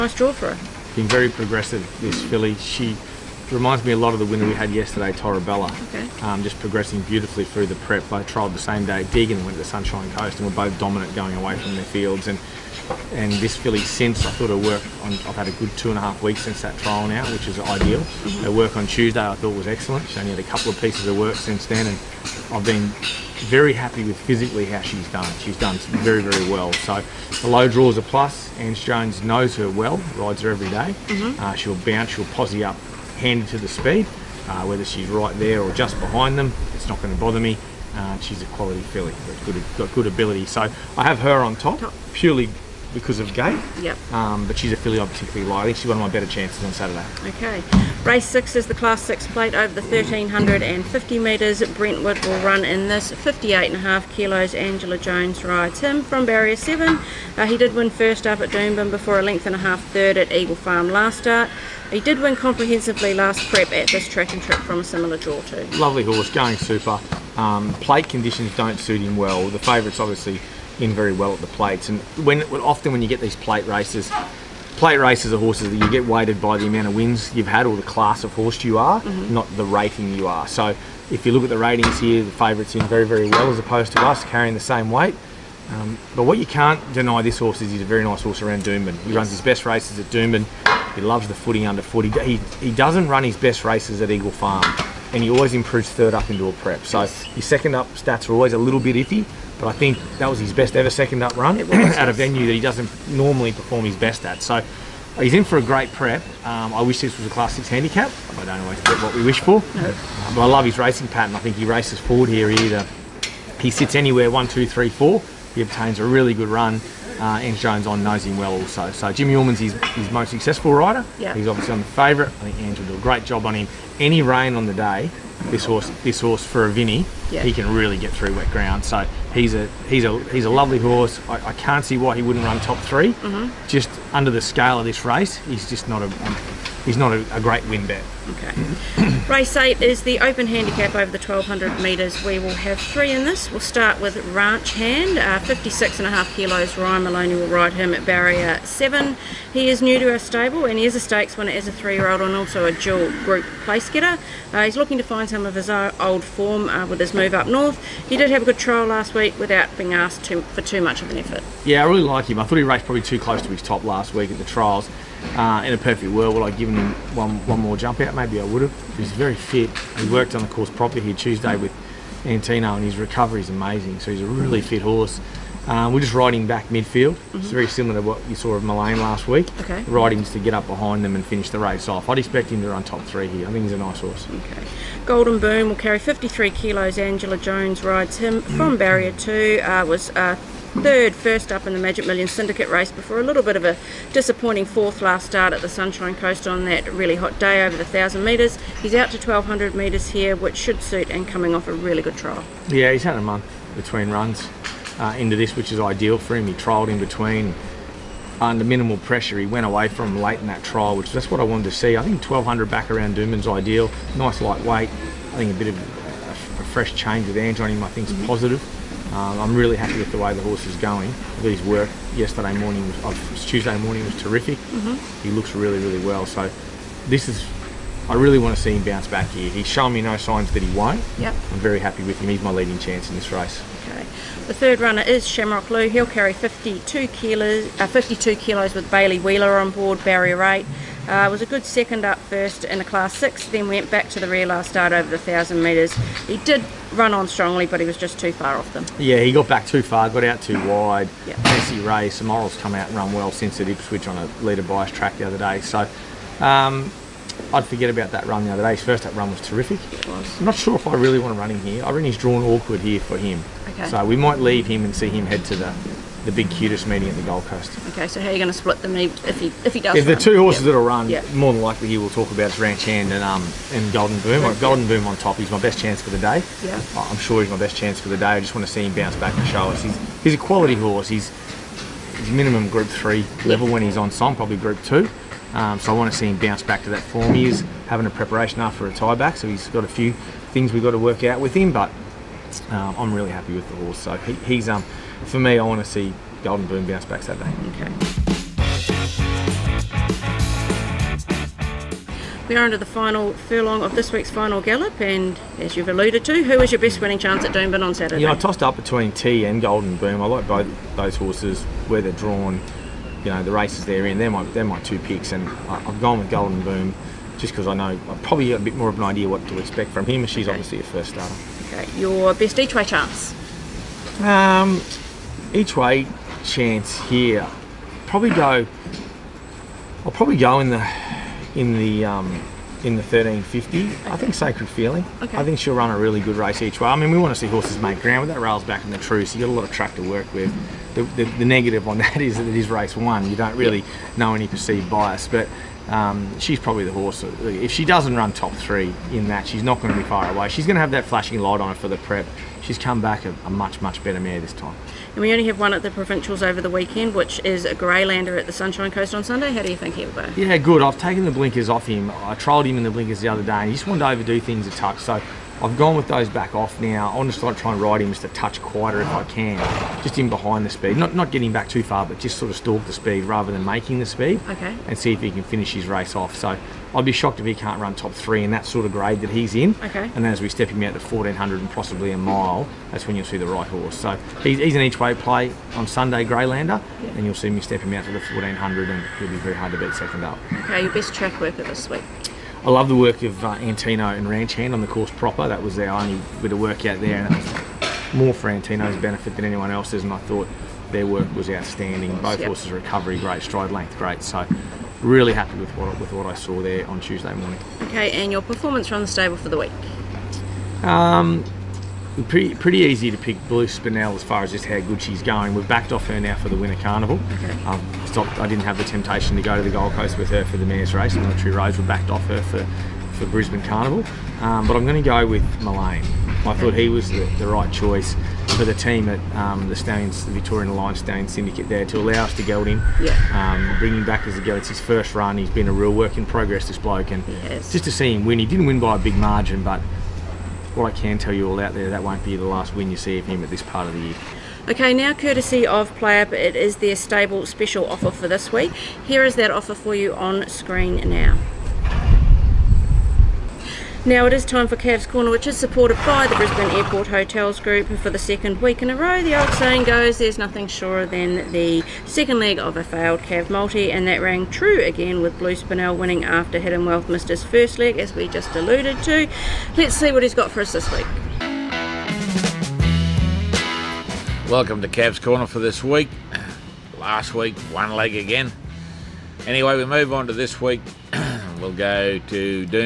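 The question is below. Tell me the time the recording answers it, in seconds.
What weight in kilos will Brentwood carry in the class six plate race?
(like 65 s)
53 s.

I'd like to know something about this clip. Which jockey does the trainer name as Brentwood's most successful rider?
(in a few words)
Jimmy Orman.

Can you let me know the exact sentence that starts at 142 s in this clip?
We will have three in this.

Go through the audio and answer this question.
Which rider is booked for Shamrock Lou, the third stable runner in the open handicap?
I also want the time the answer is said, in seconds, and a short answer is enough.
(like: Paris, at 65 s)
Bailey Wheeler, at 238 s.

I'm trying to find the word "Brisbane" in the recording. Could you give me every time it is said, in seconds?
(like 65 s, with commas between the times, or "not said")
423 s, 456 s.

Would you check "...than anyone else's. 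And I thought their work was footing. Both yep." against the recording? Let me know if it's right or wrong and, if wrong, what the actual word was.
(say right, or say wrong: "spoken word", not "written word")
wrong: "outstanding", not "footing".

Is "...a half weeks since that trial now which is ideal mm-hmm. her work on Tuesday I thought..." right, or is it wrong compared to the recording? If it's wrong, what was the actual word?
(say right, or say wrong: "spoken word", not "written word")
right.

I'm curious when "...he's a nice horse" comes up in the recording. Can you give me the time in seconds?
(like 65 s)
183 s.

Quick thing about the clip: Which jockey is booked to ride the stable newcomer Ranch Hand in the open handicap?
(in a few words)
Ryan Maloney.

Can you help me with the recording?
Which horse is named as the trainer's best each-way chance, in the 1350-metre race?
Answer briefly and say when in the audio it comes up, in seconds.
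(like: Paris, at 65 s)
Sacred Feeling, at 334 s.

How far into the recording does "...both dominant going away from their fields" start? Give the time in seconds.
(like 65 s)
10 s.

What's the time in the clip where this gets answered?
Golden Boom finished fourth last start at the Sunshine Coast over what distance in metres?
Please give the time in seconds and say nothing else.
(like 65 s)
197 s.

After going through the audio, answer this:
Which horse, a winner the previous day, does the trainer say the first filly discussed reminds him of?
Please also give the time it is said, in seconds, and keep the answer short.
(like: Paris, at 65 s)
Torabella, at 5 s.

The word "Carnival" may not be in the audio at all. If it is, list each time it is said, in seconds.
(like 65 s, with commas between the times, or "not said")
416 s, 423 s.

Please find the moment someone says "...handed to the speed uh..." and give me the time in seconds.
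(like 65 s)
33 s.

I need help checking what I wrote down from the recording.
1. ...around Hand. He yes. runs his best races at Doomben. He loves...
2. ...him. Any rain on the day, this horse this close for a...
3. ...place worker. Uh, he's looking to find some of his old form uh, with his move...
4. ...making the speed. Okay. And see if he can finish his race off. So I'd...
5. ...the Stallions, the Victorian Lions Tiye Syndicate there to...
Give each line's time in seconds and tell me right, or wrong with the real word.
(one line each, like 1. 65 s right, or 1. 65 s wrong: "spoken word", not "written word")
1. 88 s wrong: "Doomben", not "Hand"
2. 123 s wrong: "horse", not "close"
3. 153 s wrong: "getter", not "worker"
4. 373 s right
5. 429 s wrong: "Stallion", not "Tiye".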